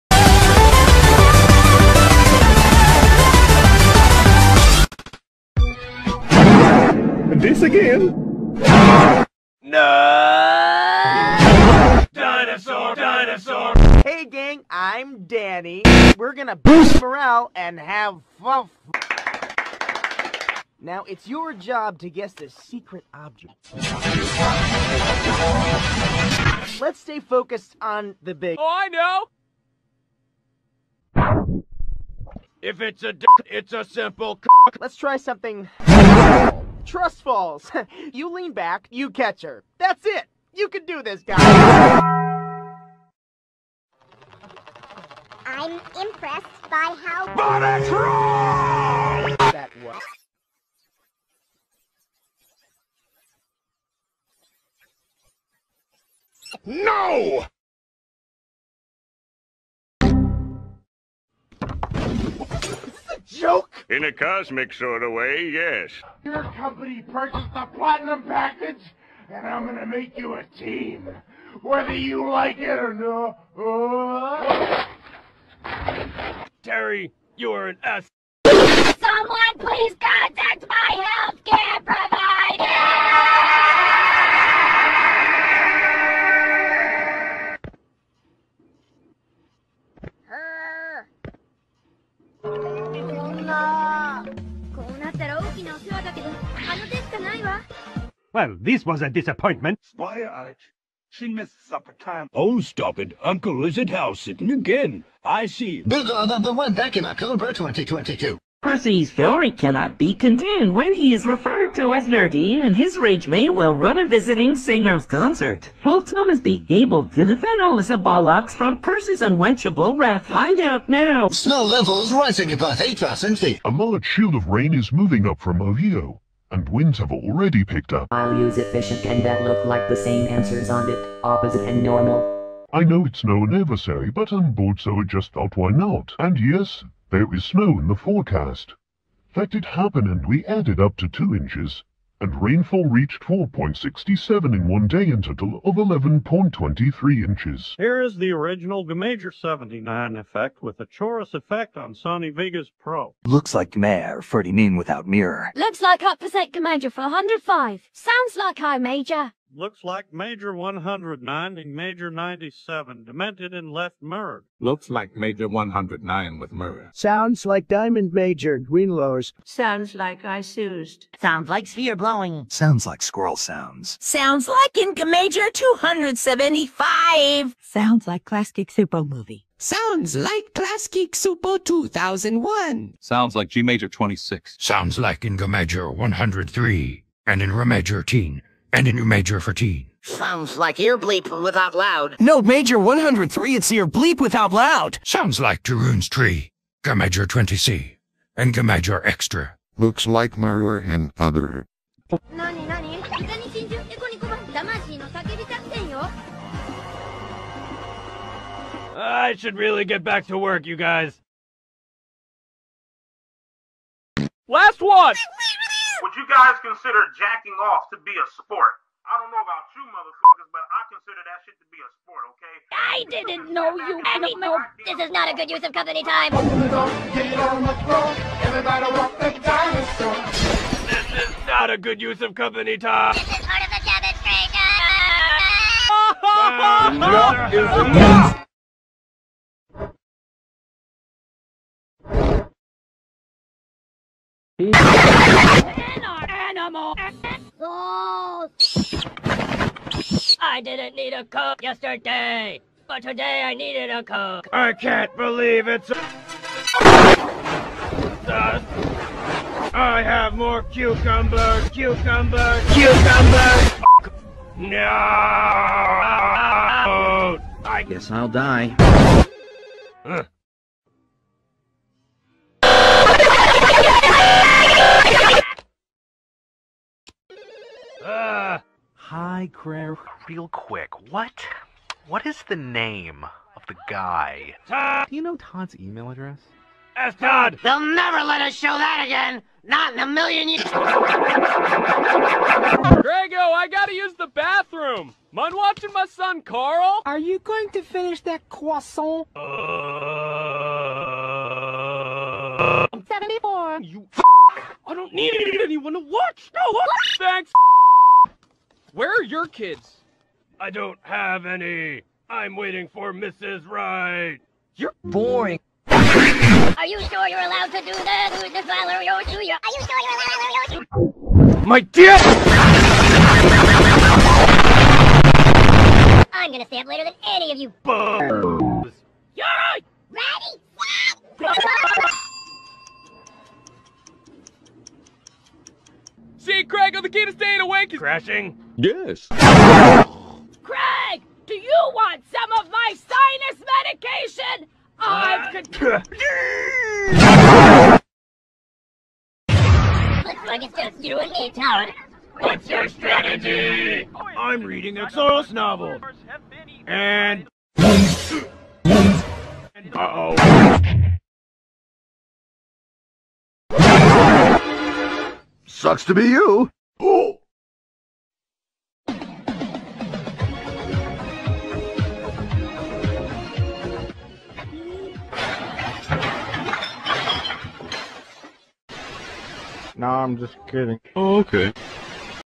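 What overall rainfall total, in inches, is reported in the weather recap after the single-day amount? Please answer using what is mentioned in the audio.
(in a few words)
11.23 inches.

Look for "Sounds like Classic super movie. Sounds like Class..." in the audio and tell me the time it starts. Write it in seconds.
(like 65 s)
177 s.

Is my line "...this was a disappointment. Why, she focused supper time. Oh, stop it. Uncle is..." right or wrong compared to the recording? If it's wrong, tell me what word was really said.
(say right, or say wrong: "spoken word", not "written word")
wrong: "missed", not "focused".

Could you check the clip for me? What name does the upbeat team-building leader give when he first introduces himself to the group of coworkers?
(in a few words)
Danny.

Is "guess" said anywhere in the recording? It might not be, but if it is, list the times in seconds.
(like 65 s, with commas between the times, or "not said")
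22 s, 267 s.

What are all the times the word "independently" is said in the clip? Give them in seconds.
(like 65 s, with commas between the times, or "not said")
not said.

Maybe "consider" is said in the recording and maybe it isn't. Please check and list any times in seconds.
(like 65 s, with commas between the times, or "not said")
216 s, 220 s.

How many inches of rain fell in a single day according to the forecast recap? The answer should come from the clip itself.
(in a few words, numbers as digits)
4.67.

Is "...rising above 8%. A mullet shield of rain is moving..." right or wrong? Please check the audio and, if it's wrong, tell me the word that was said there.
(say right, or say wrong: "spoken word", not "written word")
right.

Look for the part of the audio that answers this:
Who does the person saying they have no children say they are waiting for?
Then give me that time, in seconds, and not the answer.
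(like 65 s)
313 s.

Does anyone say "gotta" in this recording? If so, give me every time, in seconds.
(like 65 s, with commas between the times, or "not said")
293 s.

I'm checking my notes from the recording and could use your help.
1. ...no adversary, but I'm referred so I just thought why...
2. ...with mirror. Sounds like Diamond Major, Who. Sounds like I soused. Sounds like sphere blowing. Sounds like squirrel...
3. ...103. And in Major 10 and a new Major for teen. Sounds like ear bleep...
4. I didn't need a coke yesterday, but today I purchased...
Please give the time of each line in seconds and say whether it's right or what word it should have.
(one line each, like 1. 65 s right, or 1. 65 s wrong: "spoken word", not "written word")
1. 133 s wrong: "bored", not "referred"
2. 166 s wrong: "Greenlowers", not "Who"
3. 185 s right
4. 250 s wrong: "needed", not "purchased".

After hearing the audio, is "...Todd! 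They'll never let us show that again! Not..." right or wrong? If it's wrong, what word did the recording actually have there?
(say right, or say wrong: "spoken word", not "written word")
right.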